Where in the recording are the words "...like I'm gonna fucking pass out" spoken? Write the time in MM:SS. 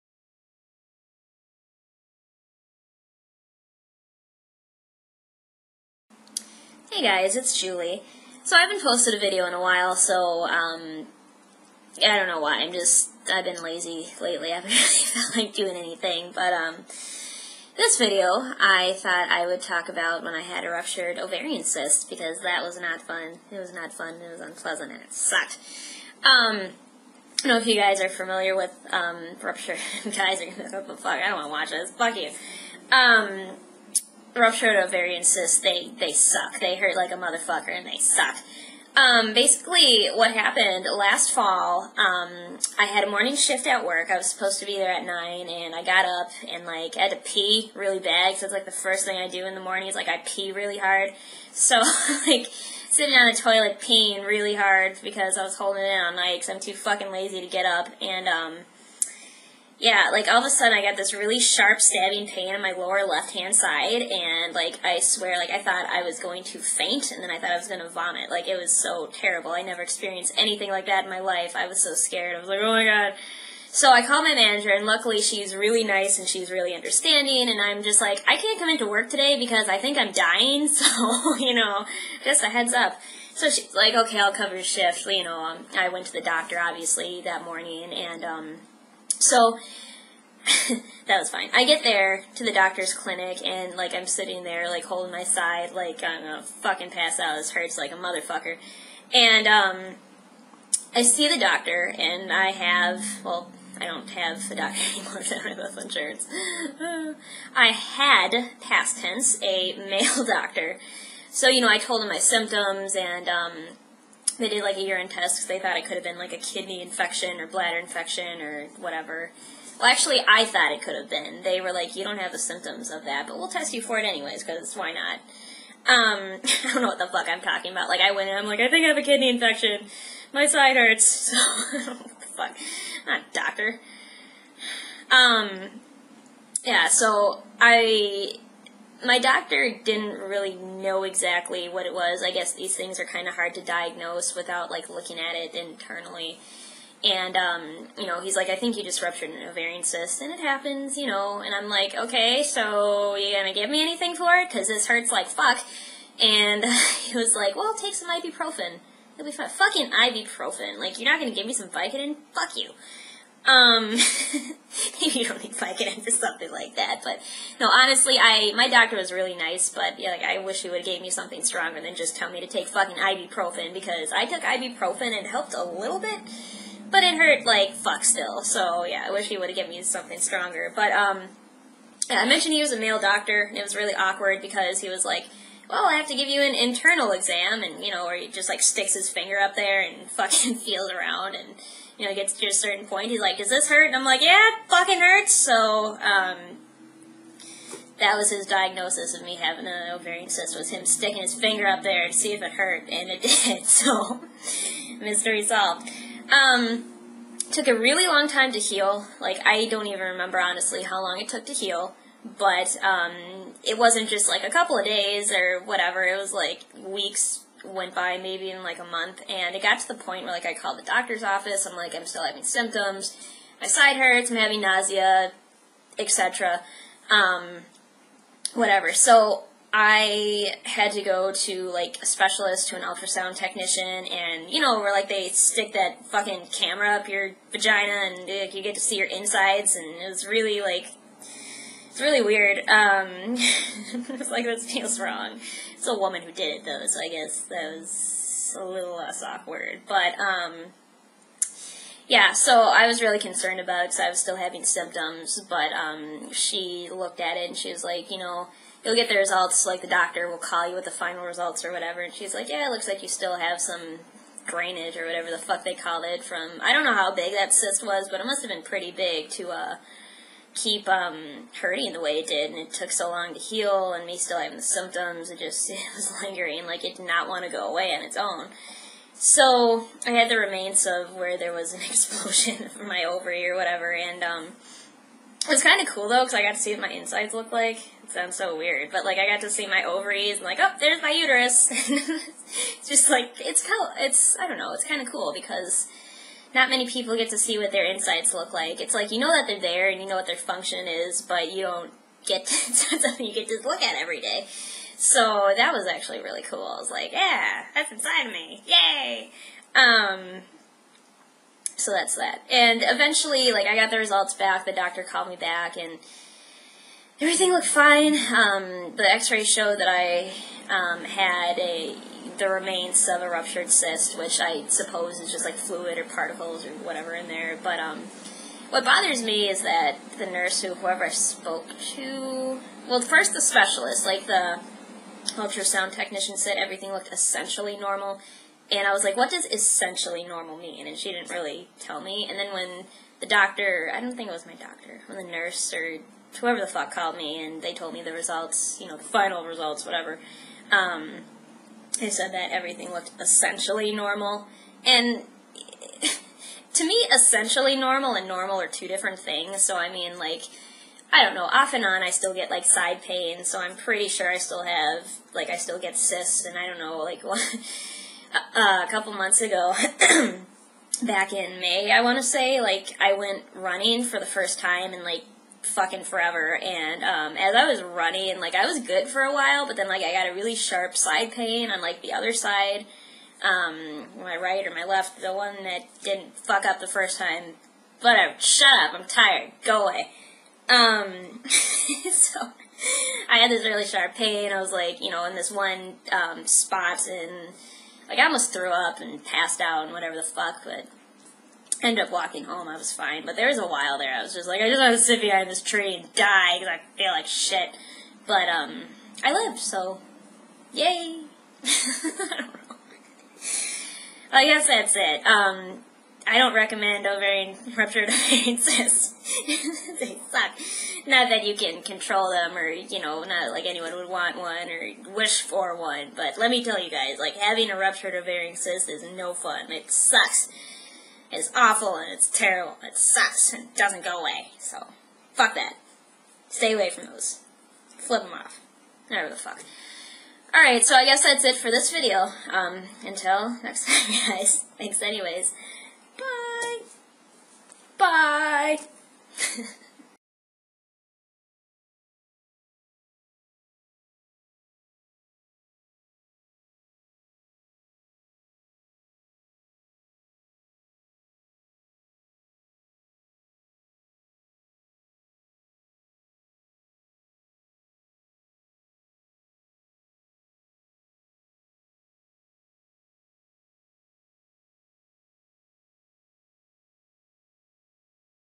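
01:35.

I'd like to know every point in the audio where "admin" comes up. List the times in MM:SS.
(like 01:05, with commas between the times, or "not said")
not said.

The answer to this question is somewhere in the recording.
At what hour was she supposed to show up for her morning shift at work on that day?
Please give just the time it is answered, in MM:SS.
00:45.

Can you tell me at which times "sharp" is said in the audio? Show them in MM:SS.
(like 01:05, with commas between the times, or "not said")
01:01, 06:20, 06:33.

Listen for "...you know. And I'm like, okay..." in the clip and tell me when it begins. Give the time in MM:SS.
02:30.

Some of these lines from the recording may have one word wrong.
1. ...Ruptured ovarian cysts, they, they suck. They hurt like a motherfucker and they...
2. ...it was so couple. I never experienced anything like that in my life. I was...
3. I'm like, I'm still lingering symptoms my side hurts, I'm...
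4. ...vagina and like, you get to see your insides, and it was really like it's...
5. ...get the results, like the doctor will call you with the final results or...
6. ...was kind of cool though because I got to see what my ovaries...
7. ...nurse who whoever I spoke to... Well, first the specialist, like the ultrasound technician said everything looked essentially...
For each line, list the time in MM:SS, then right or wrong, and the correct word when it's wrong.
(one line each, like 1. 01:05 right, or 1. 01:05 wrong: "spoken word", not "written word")
1. 00:34 right
2. 01:08 wrong: "terrible", not "couple"
3. 03:41 wrong: "having", not "lingering"
4. 03:57 right
5. 04:18 right
6. 04:45 wrong: "insides", not "ovaries"
7. 05:30 right.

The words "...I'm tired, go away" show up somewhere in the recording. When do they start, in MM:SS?
06:28.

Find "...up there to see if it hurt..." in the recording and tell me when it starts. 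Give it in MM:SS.
03:21.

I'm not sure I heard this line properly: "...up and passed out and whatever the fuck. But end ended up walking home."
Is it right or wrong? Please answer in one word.
right.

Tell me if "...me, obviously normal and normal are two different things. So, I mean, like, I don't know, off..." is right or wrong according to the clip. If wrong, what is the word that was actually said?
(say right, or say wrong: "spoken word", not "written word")
wrong: "essentially", not "obviously".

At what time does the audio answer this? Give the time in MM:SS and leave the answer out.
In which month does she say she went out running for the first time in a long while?
06:11.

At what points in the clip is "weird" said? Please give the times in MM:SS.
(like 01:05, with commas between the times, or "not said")
04:02, 04:48.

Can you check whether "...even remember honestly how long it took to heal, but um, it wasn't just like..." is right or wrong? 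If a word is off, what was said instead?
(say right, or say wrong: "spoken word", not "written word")
right.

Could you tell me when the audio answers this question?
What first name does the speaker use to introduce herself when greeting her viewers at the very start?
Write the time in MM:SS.
00:07.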